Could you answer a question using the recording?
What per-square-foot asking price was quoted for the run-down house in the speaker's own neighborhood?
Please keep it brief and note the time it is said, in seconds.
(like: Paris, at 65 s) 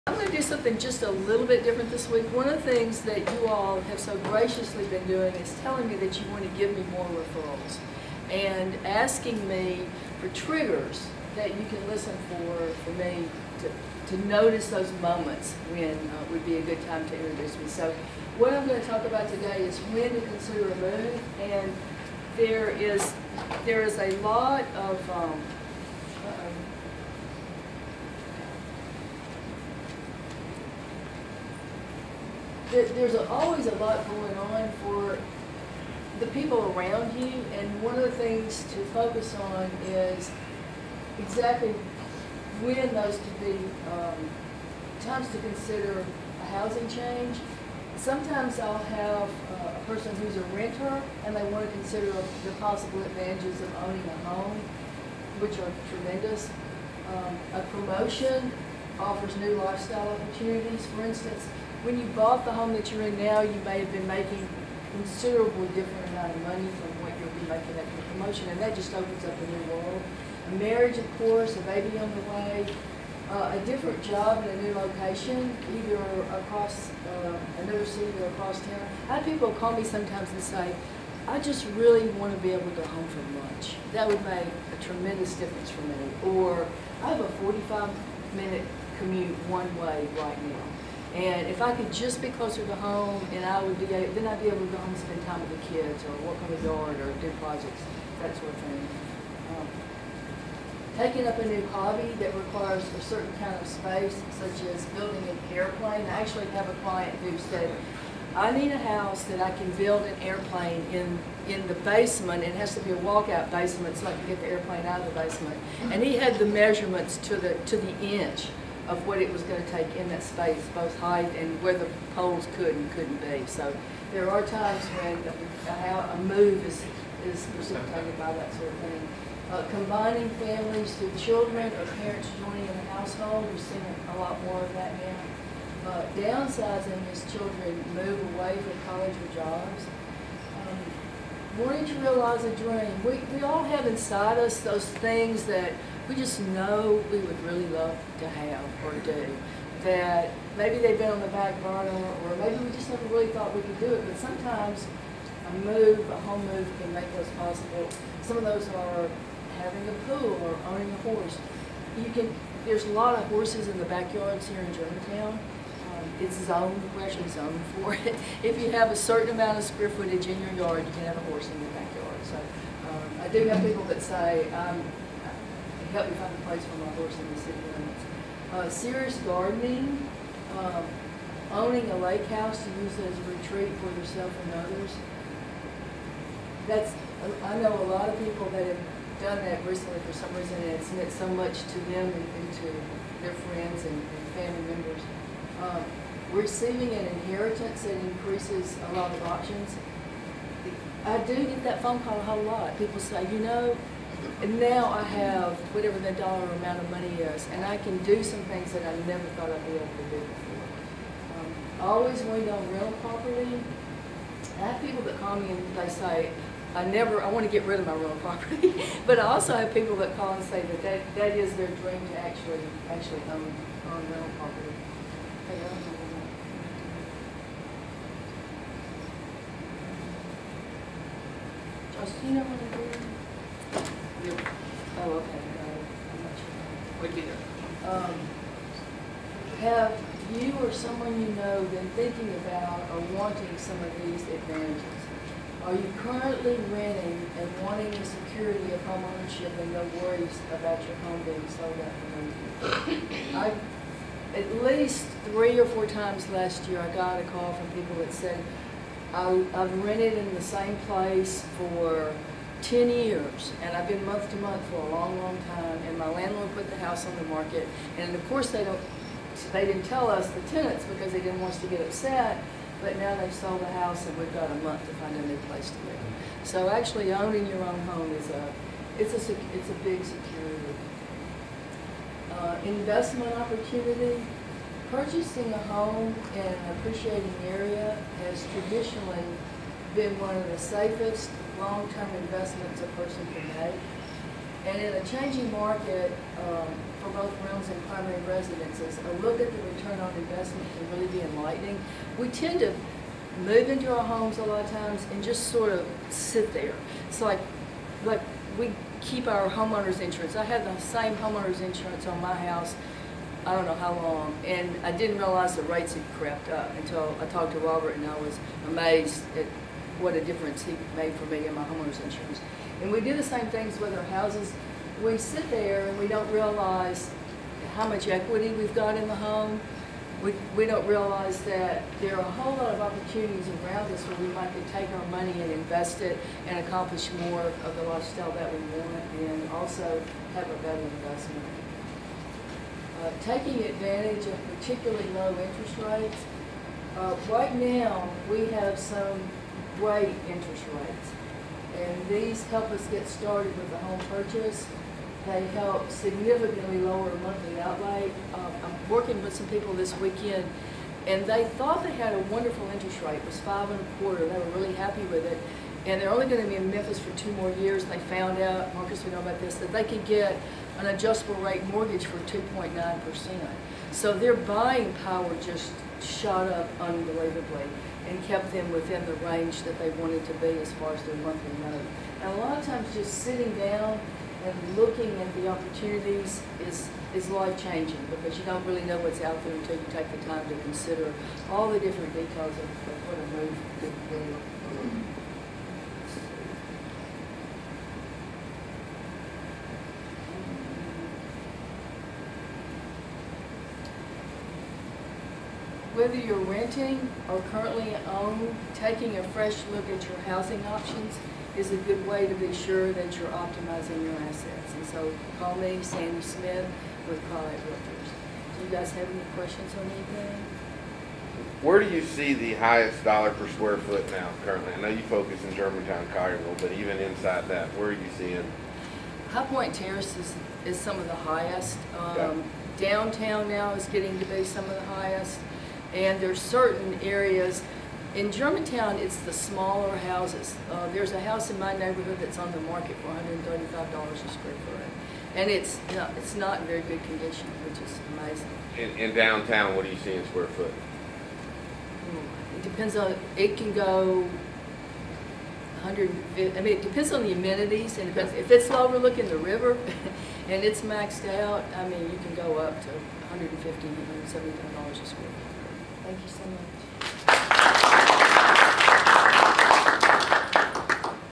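$135, at 443 s.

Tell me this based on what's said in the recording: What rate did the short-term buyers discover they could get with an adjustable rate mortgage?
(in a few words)
2.9%.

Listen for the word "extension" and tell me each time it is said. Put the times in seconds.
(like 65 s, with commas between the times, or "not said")
not said.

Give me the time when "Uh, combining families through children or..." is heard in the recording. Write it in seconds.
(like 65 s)
129 s.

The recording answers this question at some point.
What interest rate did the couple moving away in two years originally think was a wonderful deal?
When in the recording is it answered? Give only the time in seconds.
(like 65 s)
363 s.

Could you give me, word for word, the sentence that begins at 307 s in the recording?
It's like, like we keep our homeowner's insurance.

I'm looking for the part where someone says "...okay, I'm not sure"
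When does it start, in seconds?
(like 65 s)
235 s.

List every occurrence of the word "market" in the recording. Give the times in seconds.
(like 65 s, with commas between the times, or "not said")
267 s, 295 s, 442 s.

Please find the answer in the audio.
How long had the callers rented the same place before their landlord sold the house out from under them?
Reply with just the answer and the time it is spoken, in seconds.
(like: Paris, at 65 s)
10 years, at 262 s.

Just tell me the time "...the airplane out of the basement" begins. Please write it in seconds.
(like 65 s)
114 s.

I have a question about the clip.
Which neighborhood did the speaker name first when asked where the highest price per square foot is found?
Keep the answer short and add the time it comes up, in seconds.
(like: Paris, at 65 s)
High Point Terrace, at 429 s.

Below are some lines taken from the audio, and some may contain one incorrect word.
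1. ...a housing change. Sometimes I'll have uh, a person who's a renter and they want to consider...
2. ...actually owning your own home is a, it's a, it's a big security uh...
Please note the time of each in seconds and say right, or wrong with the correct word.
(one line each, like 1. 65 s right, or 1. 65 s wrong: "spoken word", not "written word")
1. 46 s right
2. 276 s right.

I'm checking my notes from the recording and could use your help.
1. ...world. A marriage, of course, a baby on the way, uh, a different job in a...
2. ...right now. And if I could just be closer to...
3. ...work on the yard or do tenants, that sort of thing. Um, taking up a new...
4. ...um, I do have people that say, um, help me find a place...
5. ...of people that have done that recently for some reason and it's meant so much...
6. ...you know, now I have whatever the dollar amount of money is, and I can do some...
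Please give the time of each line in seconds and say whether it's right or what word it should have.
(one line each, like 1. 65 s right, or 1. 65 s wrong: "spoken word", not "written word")
1. 69 s right
2. 90 s right
3. 96 s wrong: "projects", not "tenants"
4. 172 s right
5. 188 s right
6. 203 s right.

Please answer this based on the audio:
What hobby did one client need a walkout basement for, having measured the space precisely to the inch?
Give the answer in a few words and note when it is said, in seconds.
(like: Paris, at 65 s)
building an airplane, at 104 s.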